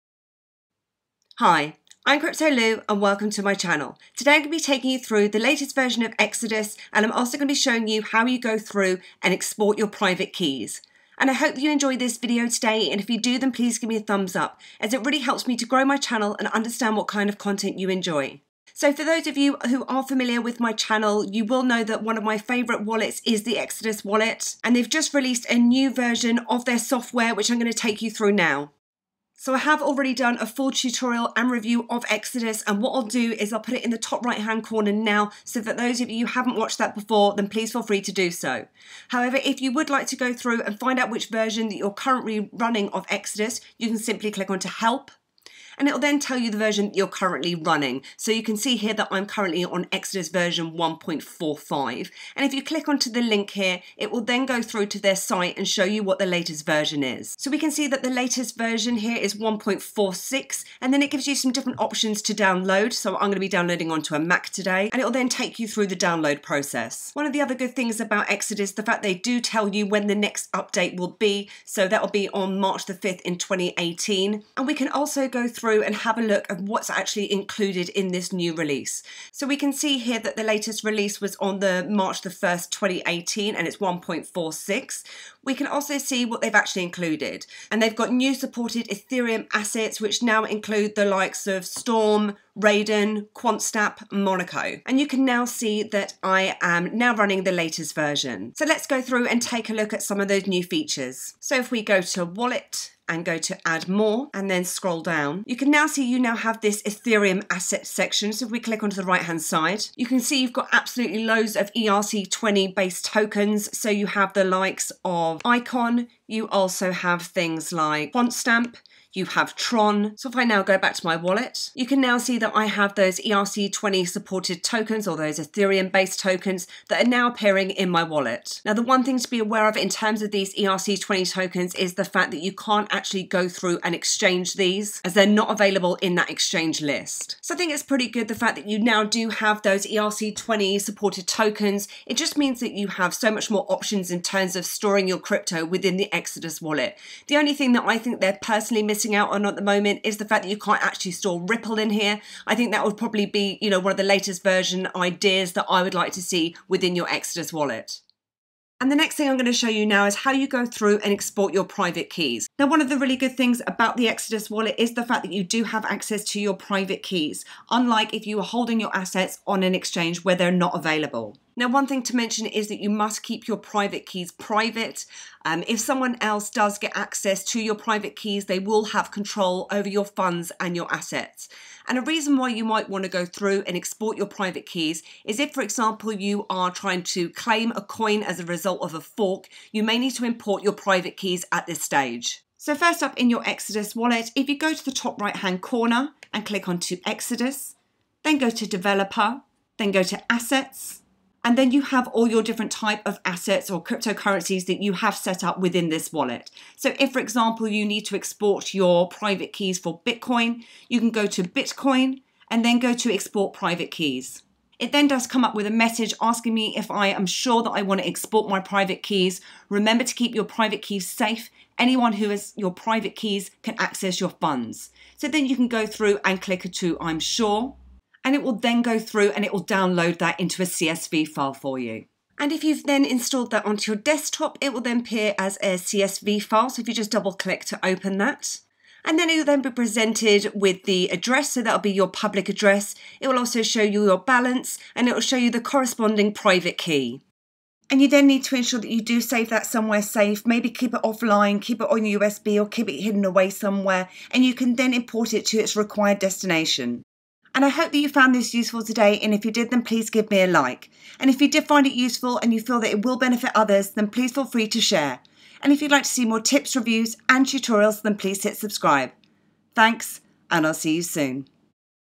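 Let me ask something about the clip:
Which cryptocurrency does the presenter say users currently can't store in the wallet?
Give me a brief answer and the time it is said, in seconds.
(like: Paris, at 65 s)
Ripple, at 151 s.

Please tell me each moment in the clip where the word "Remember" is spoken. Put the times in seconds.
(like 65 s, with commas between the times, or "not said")
219 s.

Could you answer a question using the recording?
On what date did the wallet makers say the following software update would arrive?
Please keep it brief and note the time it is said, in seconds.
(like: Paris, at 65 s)
March 5th 2018, at 72 s.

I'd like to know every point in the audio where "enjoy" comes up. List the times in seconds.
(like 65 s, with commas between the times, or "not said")
11 s, 17 s.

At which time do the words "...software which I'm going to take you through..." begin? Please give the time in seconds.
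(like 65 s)
26 s.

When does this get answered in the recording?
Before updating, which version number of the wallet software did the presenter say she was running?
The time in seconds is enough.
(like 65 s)
50 s.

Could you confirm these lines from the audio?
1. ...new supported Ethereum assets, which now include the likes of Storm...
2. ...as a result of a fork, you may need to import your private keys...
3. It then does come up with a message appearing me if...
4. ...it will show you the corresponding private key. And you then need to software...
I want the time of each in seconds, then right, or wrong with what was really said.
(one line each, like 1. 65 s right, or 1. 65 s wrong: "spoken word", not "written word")
1. 88 s right
2. 188 s right
3. 214 s wrong: "asking", not "appearing"
4. 245 s wrong: "ensure", not "software".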